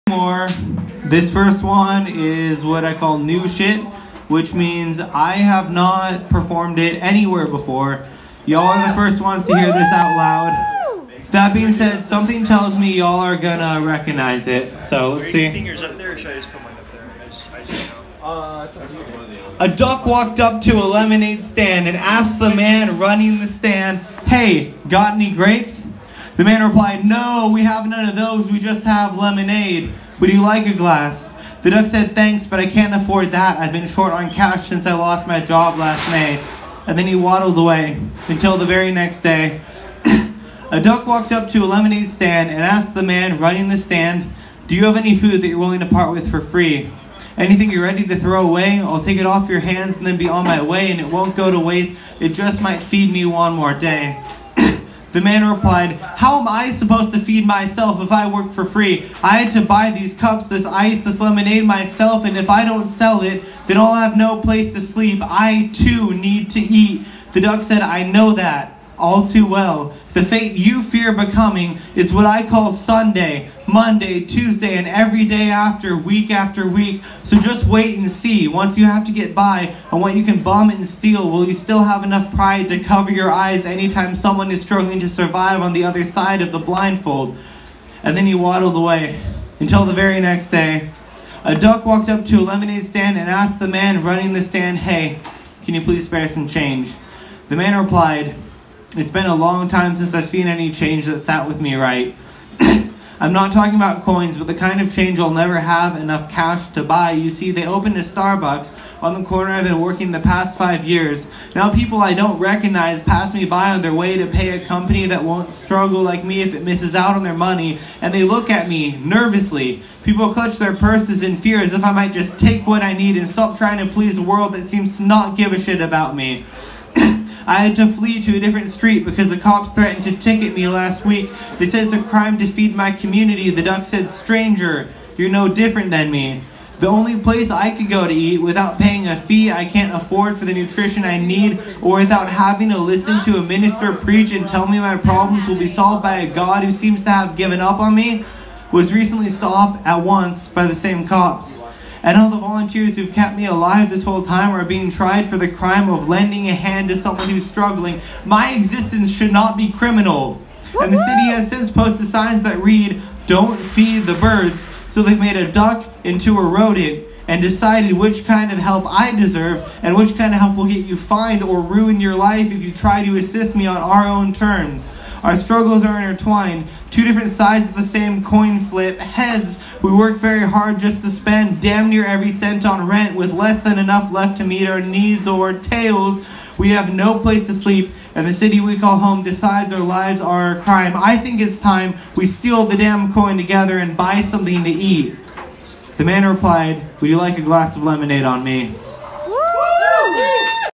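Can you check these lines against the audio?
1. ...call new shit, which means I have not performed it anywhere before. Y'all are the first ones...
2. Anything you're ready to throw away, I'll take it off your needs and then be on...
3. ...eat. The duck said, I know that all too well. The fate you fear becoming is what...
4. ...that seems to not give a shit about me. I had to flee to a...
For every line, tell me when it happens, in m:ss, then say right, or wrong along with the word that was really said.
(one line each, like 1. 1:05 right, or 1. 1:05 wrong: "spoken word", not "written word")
1. 0:02 right
2. 0:47 wrong: "hands", not "needs"
3. 1:06 right
4. 2:04 right.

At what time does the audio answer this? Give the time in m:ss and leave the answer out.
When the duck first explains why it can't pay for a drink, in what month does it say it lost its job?
0:35.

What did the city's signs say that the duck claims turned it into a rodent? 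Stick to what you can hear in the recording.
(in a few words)
Don't feed the birds.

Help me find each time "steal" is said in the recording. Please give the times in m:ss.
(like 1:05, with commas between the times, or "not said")
1:20, 3:12.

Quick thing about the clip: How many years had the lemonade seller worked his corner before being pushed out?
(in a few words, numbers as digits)
5.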